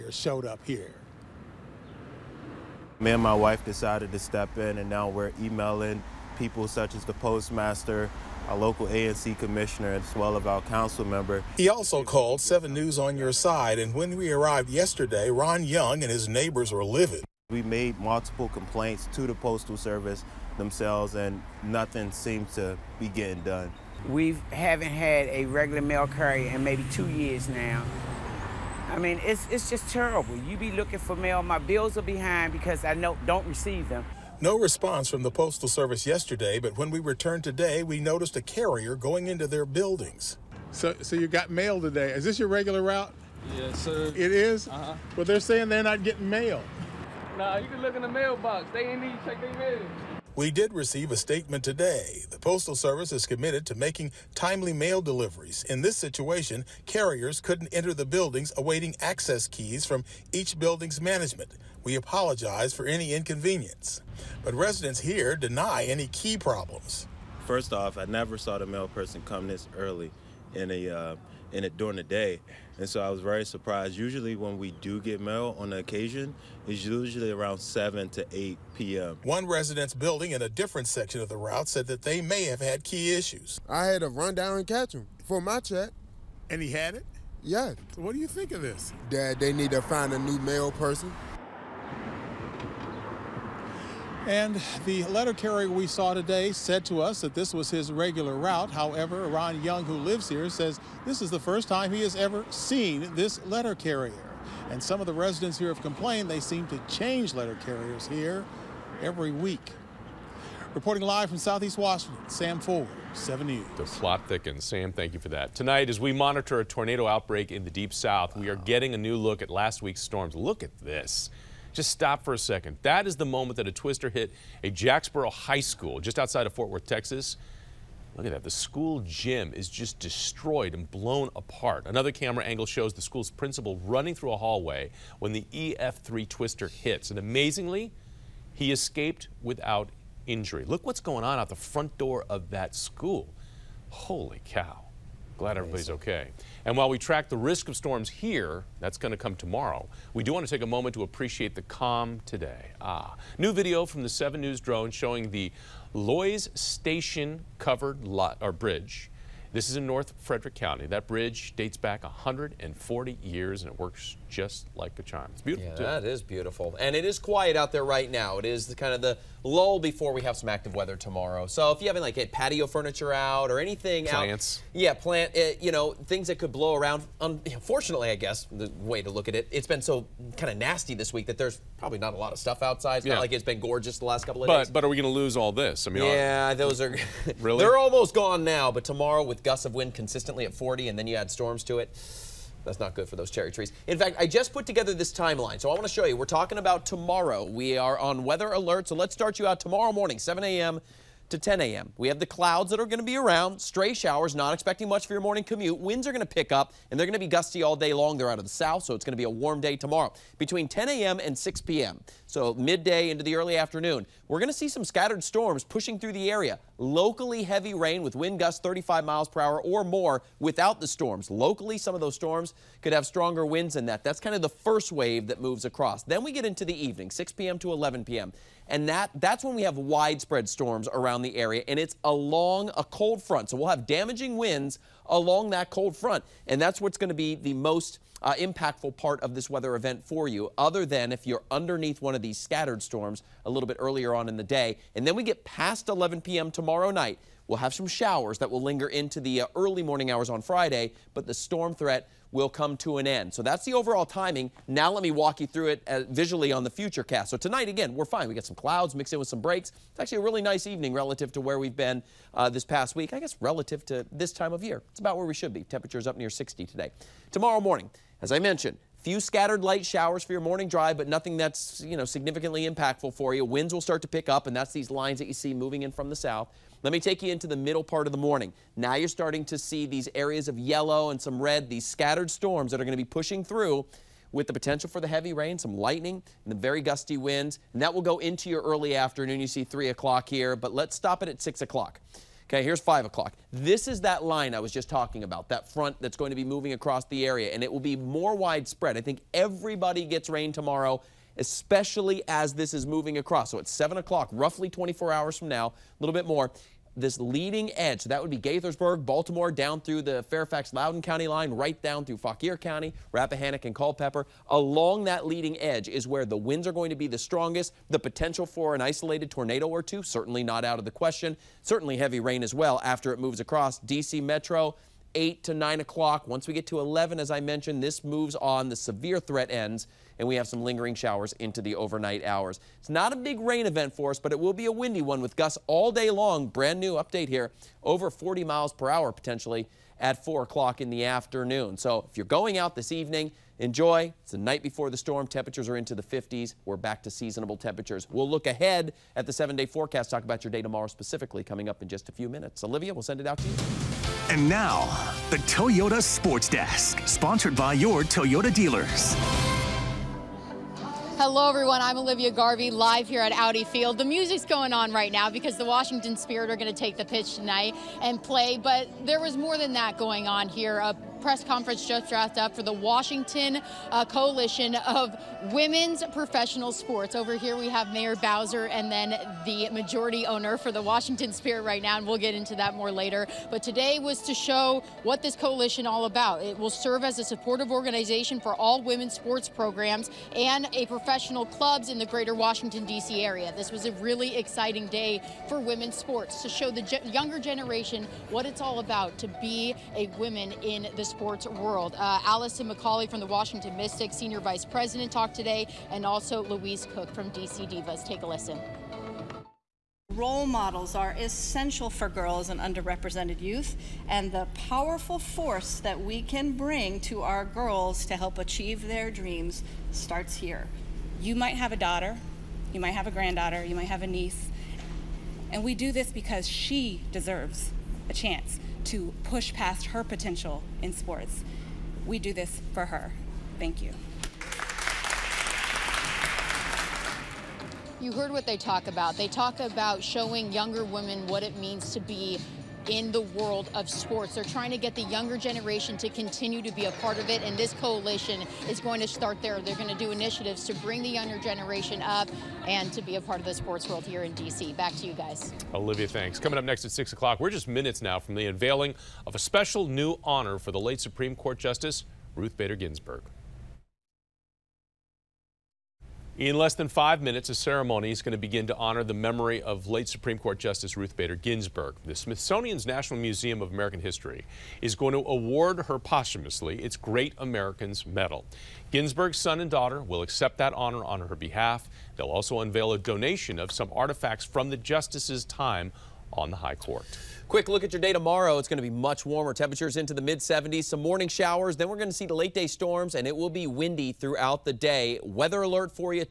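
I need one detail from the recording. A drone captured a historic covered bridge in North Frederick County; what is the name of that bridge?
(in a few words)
Loys Station.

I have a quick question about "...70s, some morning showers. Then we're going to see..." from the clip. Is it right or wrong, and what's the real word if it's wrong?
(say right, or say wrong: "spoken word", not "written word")
right.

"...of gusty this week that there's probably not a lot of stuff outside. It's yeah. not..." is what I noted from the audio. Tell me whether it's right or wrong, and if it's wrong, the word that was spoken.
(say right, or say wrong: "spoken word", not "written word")
wrong: "nasty", not "gusty".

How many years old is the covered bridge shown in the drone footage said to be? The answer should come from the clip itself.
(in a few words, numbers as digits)
140.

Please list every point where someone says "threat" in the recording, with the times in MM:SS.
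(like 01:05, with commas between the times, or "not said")
04:11, 05:29.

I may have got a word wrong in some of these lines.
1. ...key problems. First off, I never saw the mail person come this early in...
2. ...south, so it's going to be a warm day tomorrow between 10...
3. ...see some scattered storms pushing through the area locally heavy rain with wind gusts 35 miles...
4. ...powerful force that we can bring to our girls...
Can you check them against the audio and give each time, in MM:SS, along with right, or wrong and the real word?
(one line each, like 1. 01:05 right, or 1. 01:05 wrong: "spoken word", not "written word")
1. 01:06 right
2. 03:28 right
3. 03:34 right
4. 06:54 right.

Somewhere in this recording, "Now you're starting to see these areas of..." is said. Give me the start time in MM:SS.
04:38.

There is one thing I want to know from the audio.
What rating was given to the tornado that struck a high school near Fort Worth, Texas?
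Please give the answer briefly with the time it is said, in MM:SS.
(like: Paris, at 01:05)
EF3, at 02:15.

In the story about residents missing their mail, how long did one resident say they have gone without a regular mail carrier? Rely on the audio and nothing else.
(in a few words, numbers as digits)
2 years.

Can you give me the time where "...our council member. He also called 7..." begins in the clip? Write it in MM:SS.
00:10.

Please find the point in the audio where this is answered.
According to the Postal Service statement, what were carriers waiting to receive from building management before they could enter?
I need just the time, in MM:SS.
00:59.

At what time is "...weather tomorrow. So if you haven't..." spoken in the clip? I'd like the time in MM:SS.
02:50.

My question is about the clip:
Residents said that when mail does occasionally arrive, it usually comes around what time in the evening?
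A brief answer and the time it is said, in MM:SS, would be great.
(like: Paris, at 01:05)
7 to 8 p.m., at 01:17.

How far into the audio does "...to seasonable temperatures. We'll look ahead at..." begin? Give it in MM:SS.
05:47.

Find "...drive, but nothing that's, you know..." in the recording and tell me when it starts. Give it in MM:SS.
04:30.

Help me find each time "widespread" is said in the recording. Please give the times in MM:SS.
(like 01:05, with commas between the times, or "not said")
03:49, 04:58.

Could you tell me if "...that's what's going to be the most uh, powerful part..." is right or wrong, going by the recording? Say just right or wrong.
wrong.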